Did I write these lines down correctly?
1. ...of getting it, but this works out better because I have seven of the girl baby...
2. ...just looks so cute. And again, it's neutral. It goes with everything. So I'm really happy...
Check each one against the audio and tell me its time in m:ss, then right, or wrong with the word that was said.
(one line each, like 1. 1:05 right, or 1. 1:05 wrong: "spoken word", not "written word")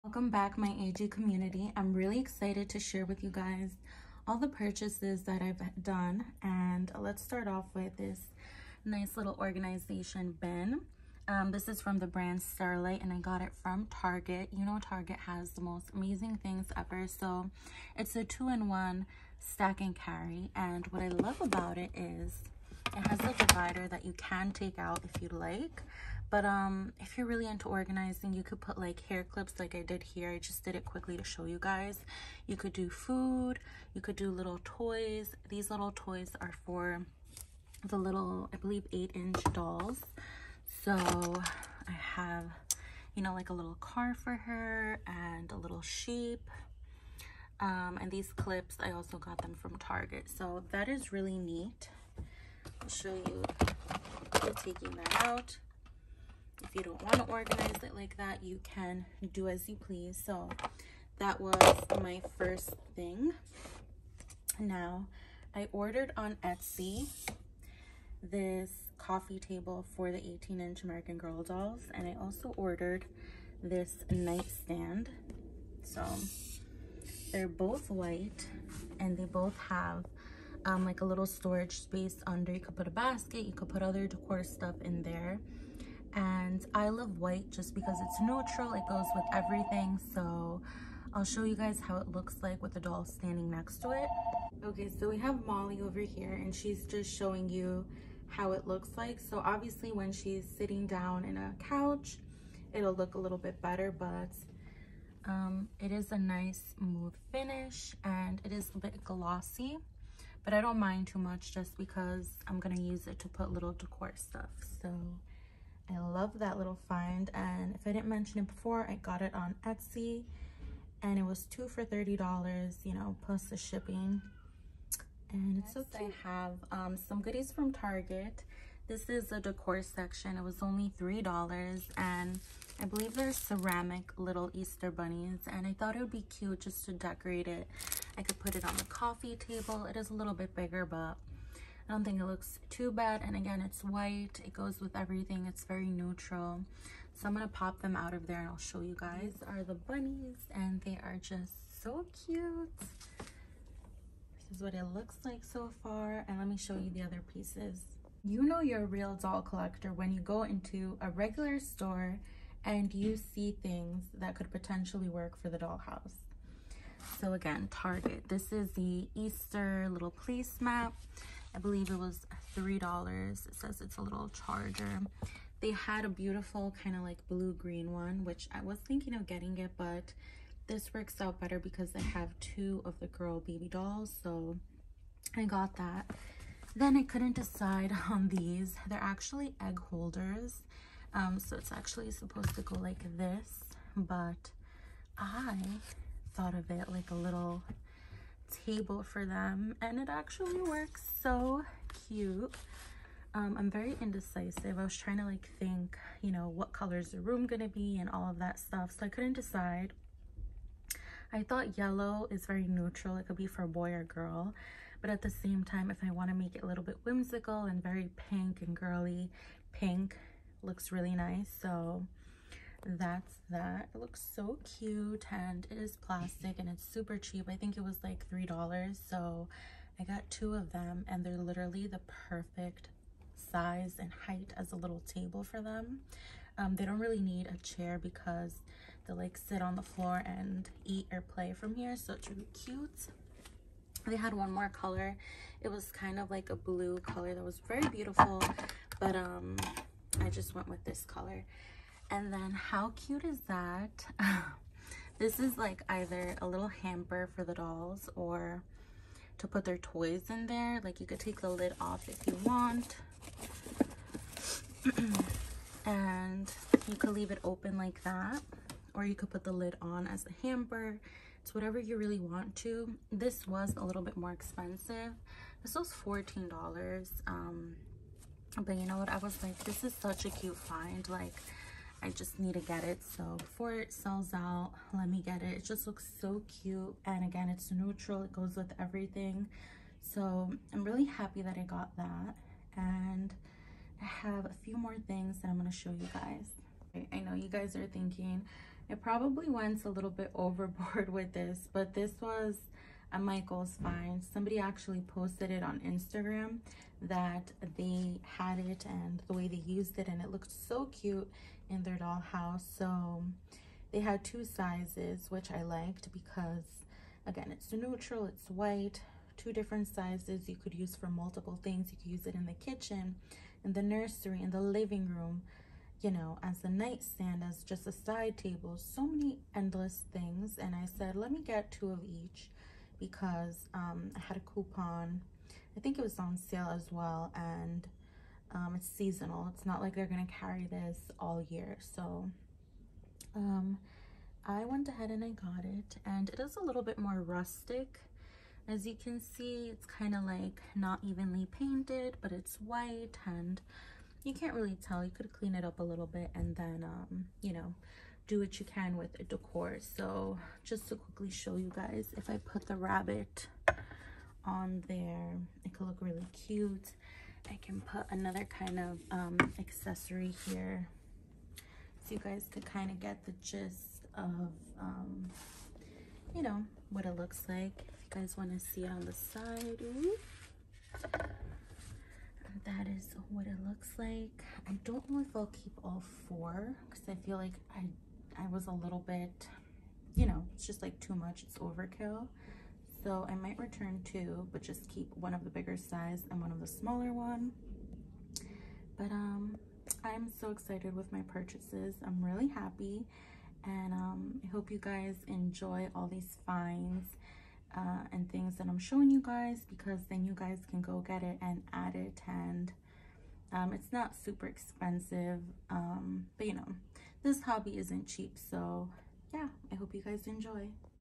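1. 2:59 wrong: "two", not "seven"
2. 4:45 right.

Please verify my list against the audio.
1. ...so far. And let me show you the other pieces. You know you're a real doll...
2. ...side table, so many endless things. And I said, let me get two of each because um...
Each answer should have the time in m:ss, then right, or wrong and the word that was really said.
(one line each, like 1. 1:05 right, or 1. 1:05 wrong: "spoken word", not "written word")
1. 2:35 right
2. 5:27 right.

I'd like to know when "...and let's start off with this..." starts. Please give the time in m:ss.
0:06.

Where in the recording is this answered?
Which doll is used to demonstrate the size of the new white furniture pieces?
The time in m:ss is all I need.
1:35.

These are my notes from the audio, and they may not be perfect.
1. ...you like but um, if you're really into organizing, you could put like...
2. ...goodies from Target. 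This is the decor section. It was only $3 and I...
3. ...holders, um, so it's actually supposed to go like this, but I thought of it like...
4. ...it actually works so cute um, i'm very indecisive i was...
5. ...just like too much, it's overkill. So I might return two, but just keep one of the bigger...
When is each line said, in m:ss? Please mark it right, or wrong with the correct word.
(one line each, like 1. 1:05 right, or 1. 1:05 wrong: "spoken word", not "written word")
1. 0:25 right
2. 2:07 right
3. 3:09 right
4. 3:19 right
5. 6:30 right.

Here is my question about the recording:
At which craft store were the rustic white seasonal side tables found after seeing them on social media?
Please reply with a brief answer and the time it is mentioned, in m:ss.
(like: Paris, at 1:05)
Michael's, at 5:03.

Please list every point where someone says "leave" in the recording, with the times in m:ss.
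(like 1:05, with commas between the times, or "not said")
4:27.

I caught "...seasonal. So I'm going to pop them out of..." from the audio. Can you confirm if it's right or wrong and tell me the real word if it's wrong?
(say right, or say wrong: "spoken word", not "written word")
wrong: "neutral", not "seasonal".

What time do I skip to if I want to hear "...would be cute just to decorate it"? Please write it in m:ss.
2:15.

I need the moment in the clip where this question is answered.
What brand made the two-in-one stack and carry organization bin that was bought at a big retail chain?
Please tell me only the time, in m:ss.
0:12.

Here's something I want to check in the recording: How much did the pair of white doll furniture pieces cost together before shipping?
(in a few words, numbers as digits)
$30.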